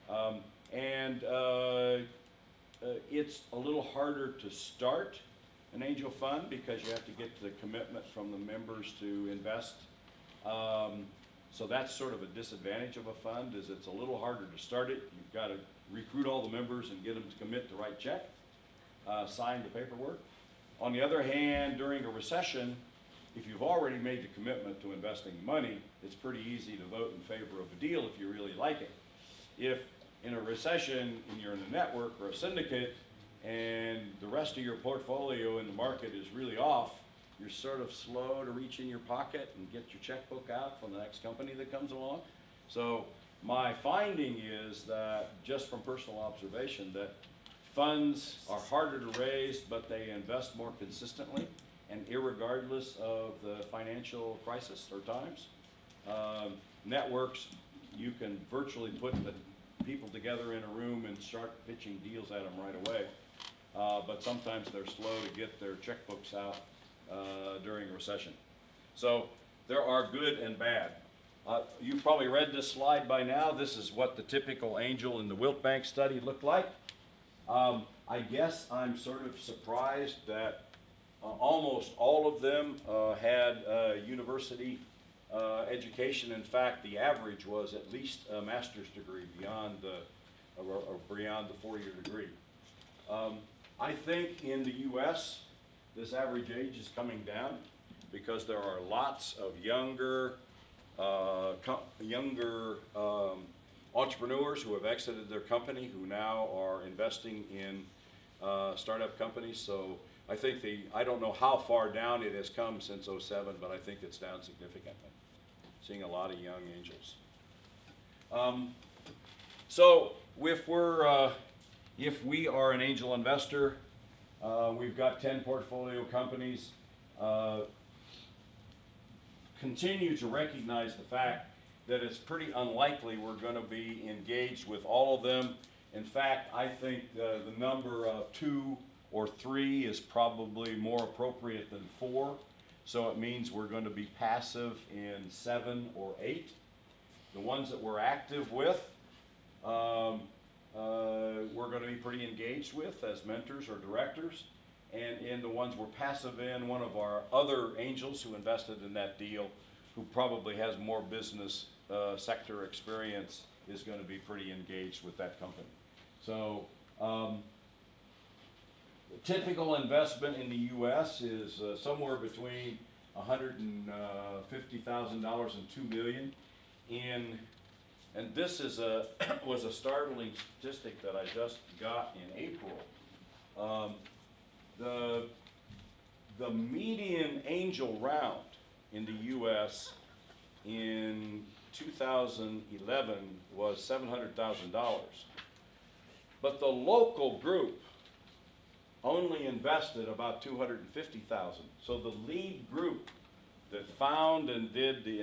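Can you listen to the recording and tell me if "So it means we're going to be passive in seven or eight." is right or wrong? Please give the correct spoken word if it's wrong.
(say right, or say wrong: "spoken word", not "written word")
right.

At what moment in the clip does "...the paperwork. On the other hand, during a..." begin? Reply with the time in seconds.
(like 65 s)
19 s.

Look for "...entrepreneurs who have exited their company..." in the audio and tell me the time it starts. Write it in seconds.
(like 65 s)
103 s.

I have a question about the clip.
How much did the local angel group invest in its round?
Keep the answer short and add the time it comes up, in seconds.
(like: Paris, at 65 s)
250,000, at 200 s.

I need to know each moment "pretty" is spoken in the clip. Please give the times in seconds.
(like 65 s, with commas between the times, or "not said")
26 s, 132 s, 151 s, 164 s.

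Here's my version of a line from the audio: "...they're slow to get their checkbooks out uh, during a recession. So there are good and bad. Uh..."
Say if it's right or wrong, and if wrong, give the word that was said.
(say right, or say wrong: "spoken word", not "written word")
right.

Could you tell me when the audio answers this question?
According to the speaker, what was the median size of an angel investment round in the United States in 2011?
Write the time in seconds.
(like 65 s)
193 s.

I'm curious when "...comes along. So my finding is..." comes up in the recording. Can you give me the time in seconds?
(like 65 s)
41 s.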